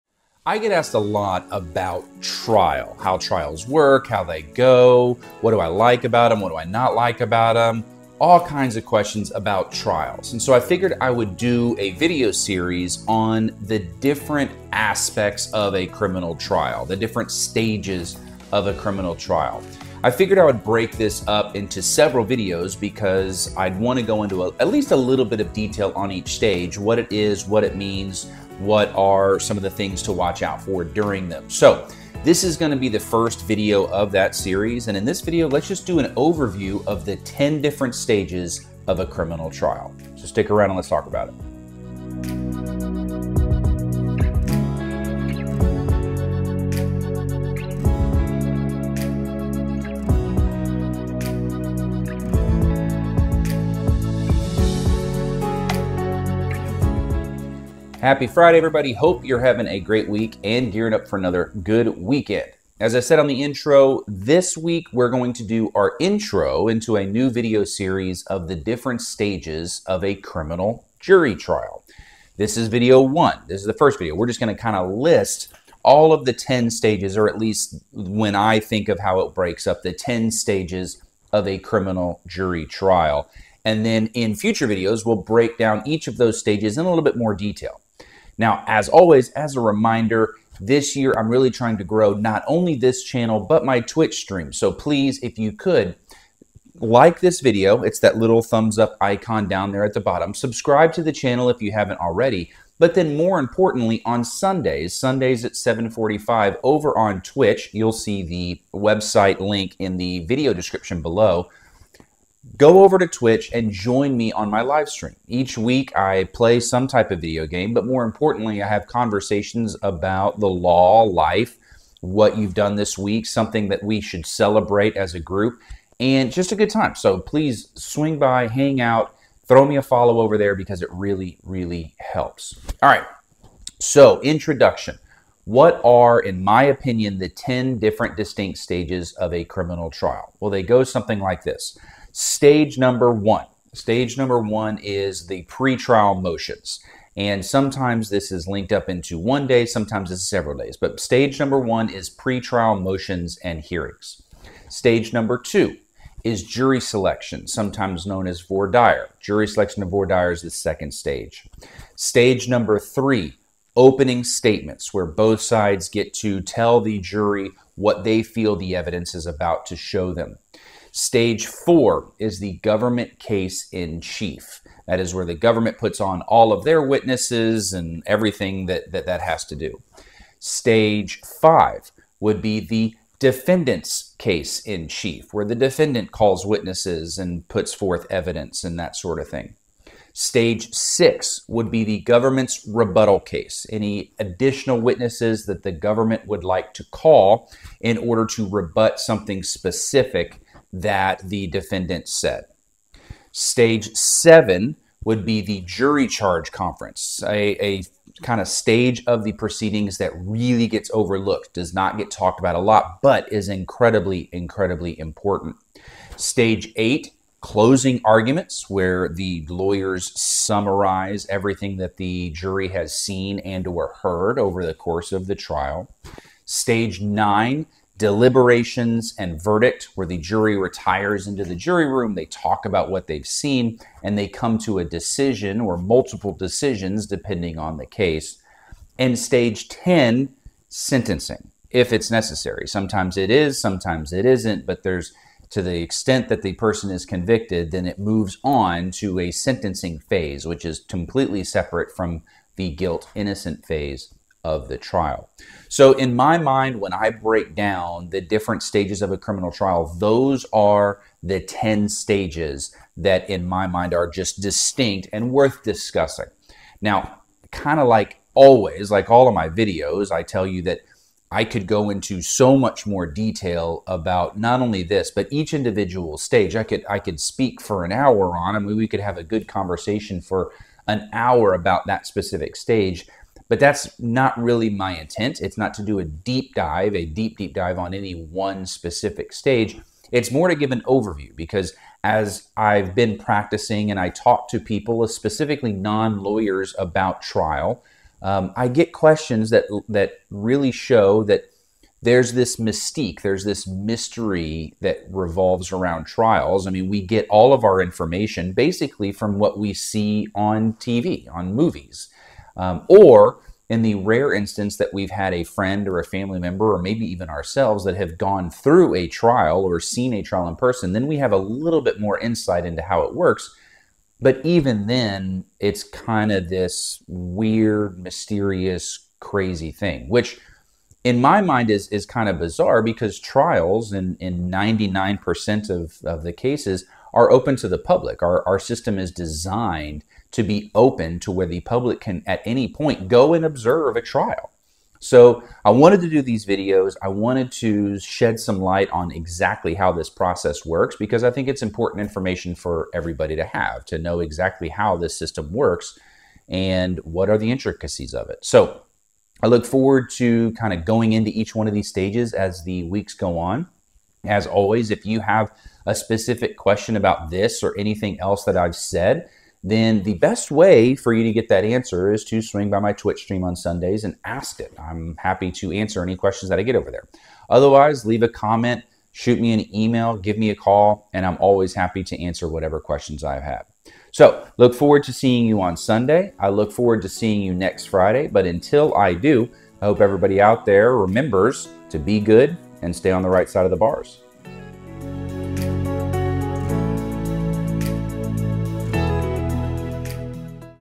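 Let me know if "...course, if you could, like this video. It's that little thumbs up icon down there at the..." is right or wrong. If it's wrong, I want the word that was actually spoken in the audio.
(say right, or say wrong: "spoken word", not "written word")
wrong: "please", not "course".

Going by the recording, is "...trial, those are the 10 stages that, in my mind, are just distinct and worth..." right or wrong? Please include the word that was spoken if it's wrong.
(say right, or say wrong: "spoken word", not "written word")
right.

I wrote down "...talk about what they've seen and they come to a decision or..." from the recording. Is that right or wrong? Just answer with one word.
right.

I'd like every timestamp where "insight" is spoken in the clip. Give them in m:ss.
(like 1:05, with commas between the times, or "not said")
5:22.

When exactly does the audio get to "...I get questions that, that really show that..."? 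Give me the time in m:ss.
4:58.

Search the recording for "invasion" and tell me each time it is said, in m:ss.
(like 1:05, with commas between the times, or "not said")
not said.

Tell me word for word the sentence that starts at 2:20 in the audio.
Well, they go something like this.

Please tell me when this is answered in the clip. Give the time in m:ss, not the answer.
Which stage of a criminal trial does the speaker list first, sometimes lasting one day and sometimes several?
2:32.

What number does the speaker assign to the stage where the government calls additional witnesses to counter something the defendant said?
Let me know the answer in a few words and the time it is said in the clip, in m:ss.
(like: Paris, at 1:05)
6, at 3:10.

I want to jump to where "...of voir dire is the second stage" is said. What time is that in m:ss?
2:39.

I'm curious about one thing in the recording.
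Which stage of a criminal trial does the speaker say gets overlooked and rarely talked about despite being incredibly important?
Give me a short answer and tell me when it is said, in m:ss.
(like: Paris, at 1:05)
jury charge conference, at 3:25.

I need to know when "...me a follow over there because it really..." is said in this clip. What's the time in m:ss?
2:09.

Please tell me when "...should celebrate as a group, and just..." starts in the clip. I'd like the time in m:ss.
2:04.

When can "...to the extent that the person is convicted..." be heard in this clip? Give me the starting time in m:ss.
4:05.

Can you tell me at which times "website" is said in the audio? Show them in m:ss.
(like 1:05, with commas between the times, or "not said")
1:48.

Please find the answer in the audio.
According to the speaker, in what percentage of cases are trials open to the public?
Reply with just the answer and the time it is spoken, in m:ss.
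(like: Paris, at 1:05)
99%, at 5:34.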